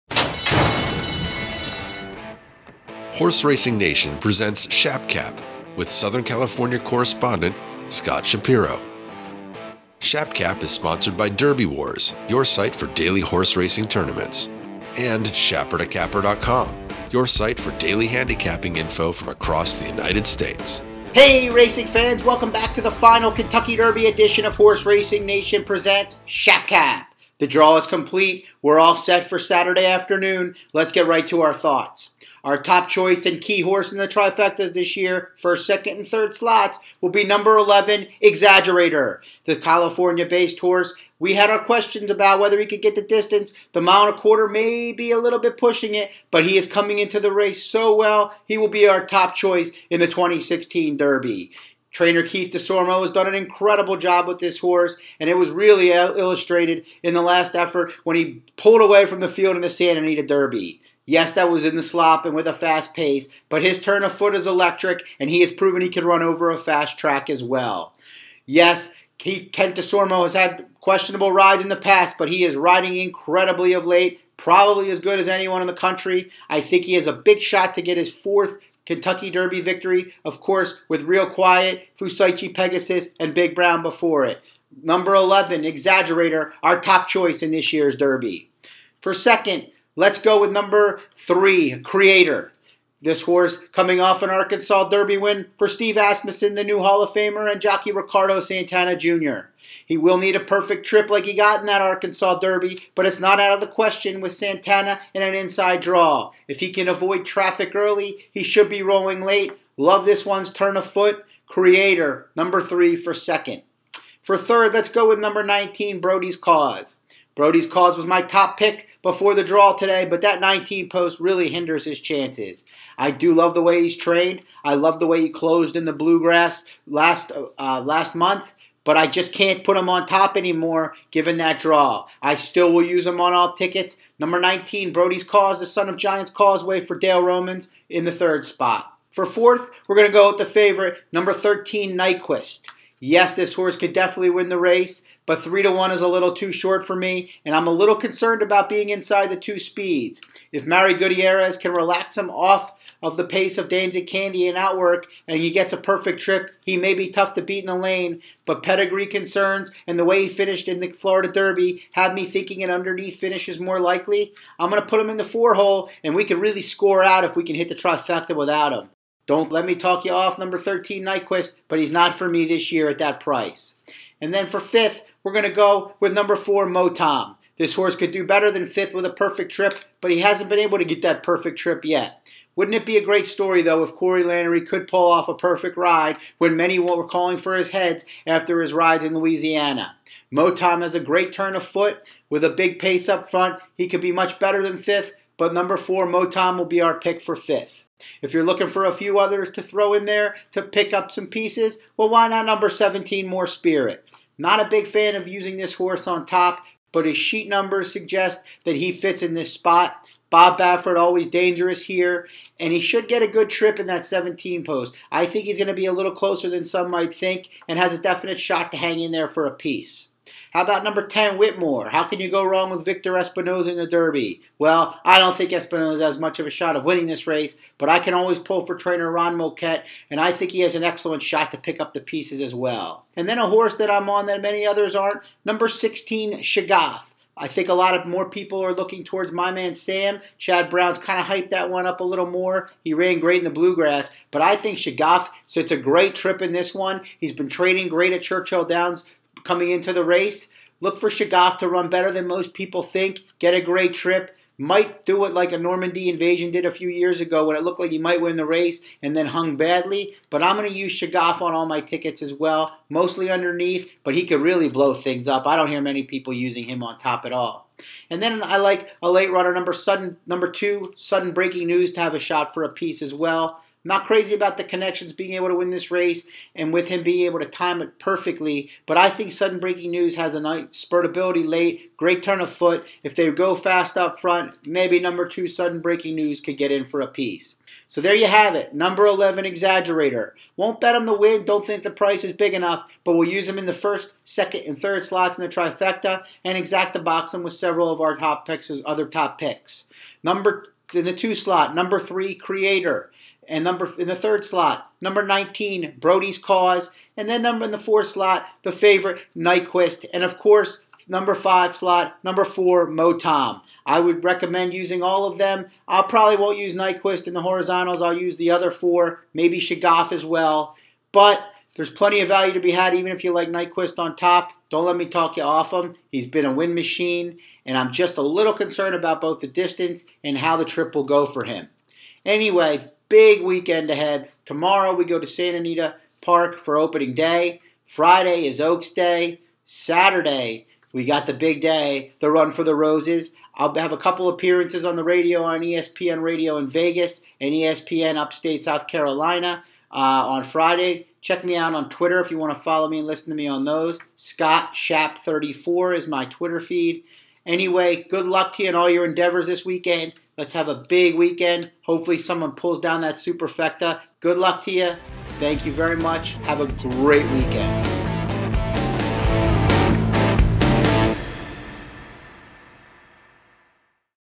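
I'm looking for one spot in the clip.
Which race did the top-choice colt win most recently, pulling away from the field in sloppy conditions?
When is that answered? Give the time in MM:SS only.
00:59.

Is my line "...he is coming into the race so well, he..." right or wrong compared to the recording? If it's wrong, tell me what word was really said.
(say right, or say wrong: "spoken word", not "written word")
right.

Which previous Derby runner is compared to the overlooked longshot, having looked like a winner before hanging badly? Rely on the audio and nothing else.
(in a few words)
Normandy Invasion.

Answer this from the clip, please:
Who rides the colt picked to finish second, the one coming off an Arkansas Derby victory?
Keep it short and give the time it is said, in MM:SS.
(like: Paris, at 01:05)
Ricardo Santana Jr., at 01:37.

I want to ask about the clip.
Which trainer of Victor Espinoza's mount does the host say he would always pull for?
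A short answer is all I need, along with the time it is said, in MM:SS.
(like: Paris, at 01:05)
Ron Moquett, at 03:49.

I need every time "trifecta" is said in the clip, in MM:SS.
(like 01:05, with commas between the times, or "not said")
00:34, 02:47, 04:55.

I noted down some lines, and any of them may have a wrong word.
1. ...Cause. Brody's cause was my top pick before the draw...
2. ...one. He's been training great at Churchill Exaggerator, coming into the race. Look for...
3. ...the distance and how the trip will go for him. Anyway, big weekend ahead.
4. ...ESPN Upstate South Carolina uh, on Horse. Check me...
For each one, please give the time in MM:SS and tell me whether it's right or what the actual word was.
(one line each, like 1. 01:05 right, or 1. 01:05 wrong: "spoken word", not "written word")
1. 01:56 right
2. 04:06 wrong: "Downs", not "Exaggerator"
3. 05:29 right
4. 05:47 wrong: "Friday", not "Horse".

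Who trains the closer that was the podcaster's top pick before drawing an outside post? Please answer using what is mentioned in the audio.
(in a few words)
Dale Romans.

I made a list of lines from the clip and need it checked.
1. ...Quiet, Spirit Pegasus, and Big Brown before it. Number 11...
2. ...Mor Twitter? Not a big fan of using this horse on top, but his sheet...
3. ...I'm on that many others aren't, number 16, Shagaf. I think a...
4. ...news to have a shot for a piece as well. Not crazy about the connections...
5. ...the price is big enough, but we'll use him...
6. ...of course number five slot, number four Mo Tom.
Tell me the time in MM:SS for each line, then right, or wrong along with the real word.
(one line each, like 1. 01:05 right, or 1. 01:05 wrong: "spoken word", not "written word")
1. 01:21 wrong: "Fusaichi", not "Spirit"
2. 03:23 wrong: "Spirit", not "Twitter"
3. 03:53 right
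4. 04:31 right
5. 04:51 right
6. 05:10 right.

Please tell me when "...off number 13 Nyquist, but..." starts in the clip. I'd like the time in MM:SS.
02:50.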